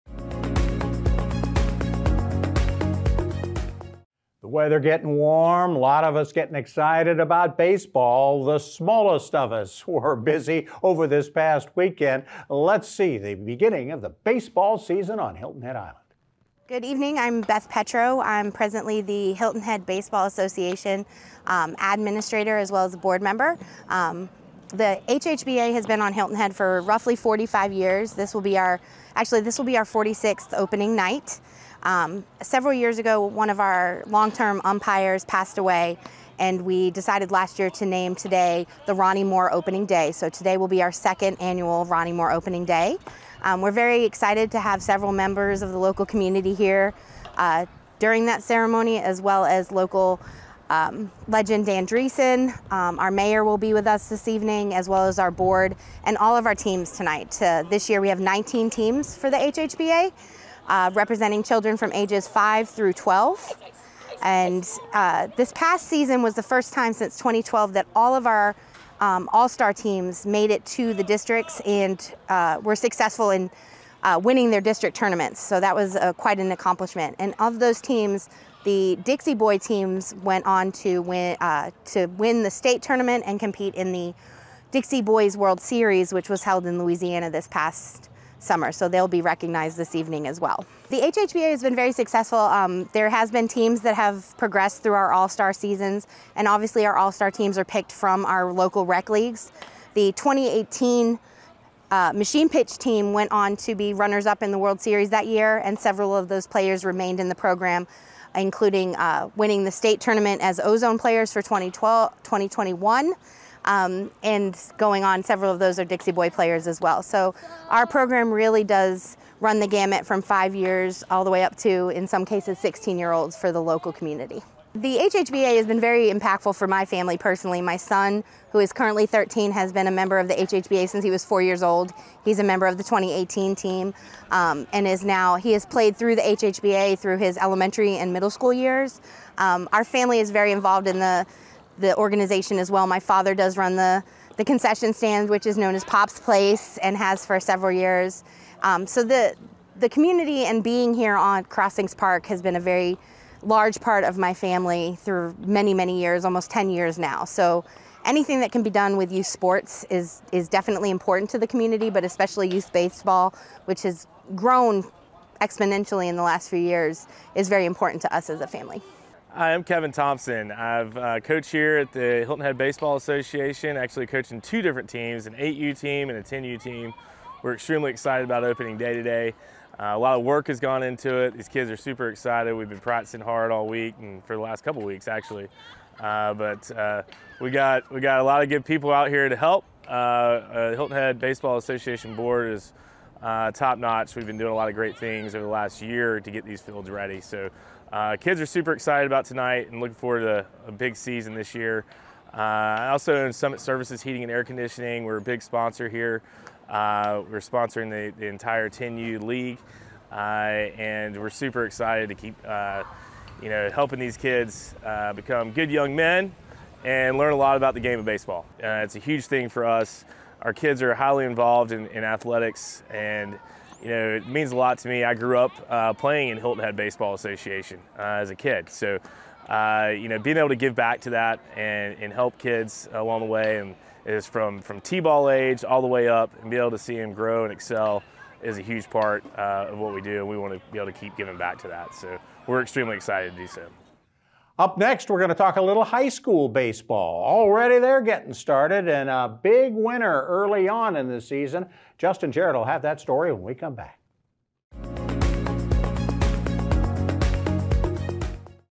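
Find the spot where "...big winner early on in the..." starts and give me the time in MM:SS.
04:09.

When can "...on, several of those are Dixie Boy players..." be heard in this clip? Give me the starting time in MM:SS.
01:55.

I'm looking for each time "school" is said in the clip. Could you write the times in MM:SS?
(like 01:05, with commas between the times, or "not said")
02:18, 04:06.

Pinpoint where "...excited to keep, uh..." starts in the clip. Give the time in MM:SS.
03:31.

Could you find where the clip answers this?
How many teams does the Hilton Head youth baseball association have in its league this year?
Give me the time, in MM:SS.
00:58.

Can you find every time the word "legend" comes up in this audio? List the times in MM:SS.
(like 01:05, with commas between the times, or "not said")
00:51.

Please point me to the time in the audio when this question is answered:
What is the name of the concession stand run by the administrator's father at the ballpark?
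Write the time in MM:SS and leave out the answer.
02:25.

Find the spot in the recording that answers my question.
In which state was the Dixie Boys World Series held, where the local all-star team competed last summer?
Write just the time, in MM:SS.
01:26.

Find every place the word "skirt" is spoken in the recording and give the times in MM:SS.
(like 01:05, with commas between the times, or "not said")
not said.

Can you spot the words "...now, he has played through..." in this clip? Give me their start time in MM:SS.
02:15.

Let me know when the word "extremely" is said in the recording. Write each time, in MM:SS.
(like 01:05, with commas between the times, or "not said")
02:57, 04:02.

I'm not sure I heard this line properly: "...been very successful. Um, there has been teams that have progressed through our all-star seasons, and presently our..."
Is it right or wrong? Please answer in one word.
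wrong.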